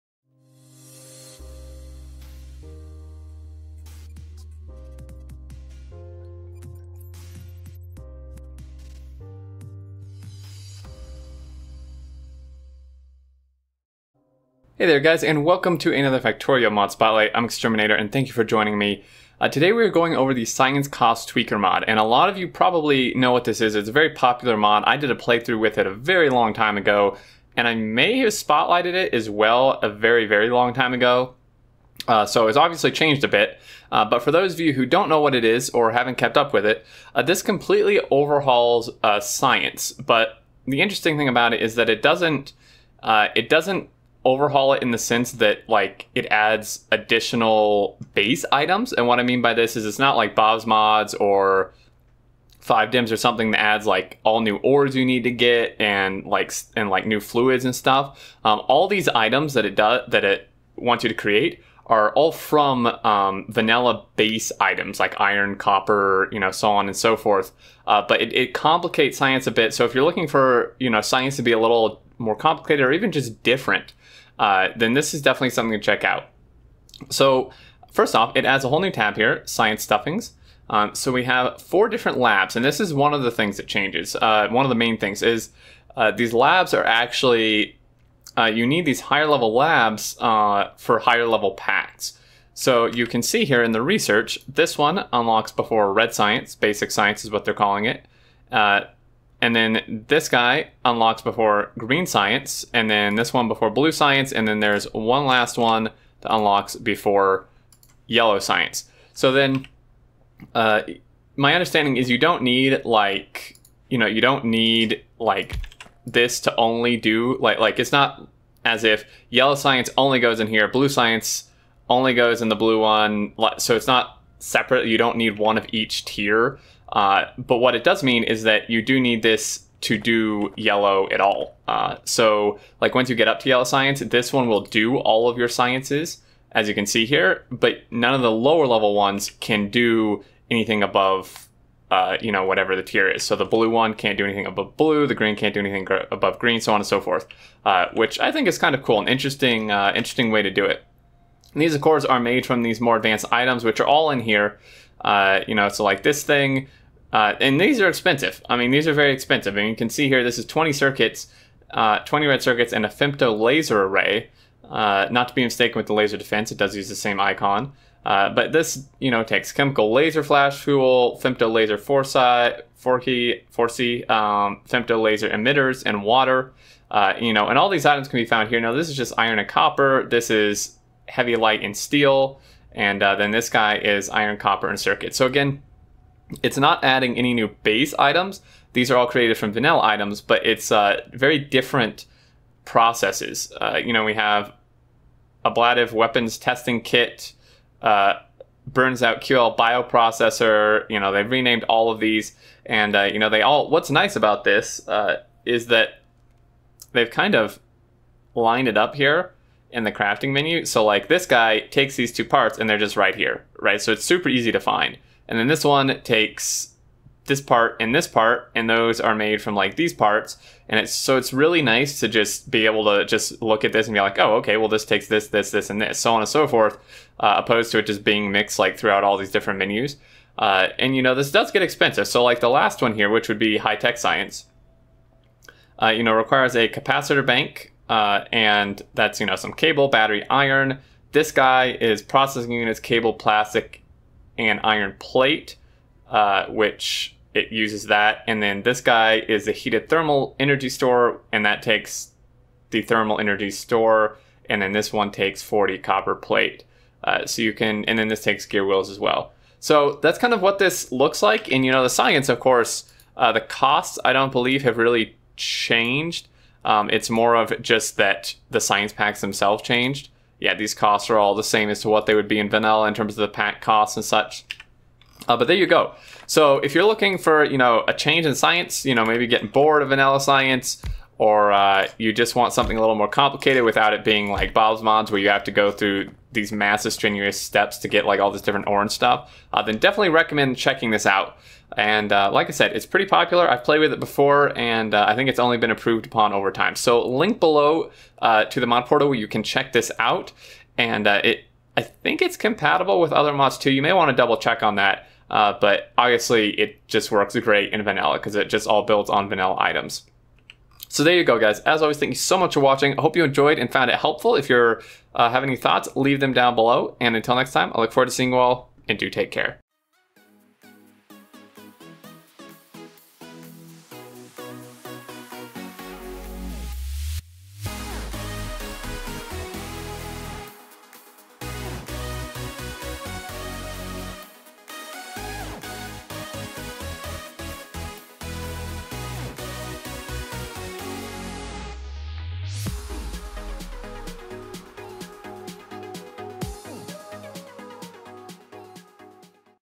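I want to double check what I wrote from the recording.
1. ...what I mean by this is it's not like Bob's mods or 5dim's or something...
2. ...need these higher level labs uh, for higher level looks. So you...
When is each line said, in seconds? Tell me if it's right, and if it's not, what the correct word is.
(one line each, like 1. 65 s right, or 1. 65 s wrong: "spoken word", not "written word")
1. 49 s right
2. 88 s wrong: "packs", not "looks".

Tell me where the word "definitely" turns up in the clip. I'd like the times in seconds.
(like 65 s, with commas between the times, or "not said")
75 s, 289 s.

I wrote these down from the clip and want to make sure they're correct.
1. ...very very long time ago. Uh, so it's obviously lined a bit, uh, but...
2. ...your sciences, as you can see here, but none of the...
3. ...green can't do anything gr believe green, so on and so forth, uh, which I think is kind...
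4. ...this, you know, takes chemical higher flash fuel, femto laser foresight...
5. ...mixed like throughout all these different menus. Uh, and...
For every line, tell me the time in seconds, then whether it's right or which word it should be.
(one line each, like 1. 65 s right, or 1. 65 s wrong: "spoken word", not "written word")
1. 29 s wrong: "changed", not "lined"
2. 135 s right
3. 145 s wrong: "above", not "believe"
4. 168 s wrong: "laser", not "higher"
5. 228 s right.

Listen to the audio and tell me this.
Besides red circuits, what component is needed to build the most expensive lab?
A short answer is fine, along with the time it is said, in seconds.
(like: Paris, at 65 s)
femto laser array, at 162 s.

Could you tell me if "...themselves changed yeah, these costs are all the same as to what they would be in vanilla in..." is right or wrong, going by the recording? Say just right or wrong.
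right.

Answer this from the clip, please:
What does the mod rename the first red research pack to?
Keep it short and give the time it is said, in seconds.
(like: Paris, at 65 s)
basic science, at 96 s.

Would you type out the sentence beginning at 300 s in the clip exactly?
And uh, it, I think it's compatible with other mods too.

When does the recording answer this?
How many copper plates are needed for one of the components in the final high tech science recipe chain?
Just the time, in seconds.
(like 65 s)
255 s.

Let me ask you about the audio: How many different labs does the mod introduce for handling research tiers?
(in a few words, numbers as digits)
4.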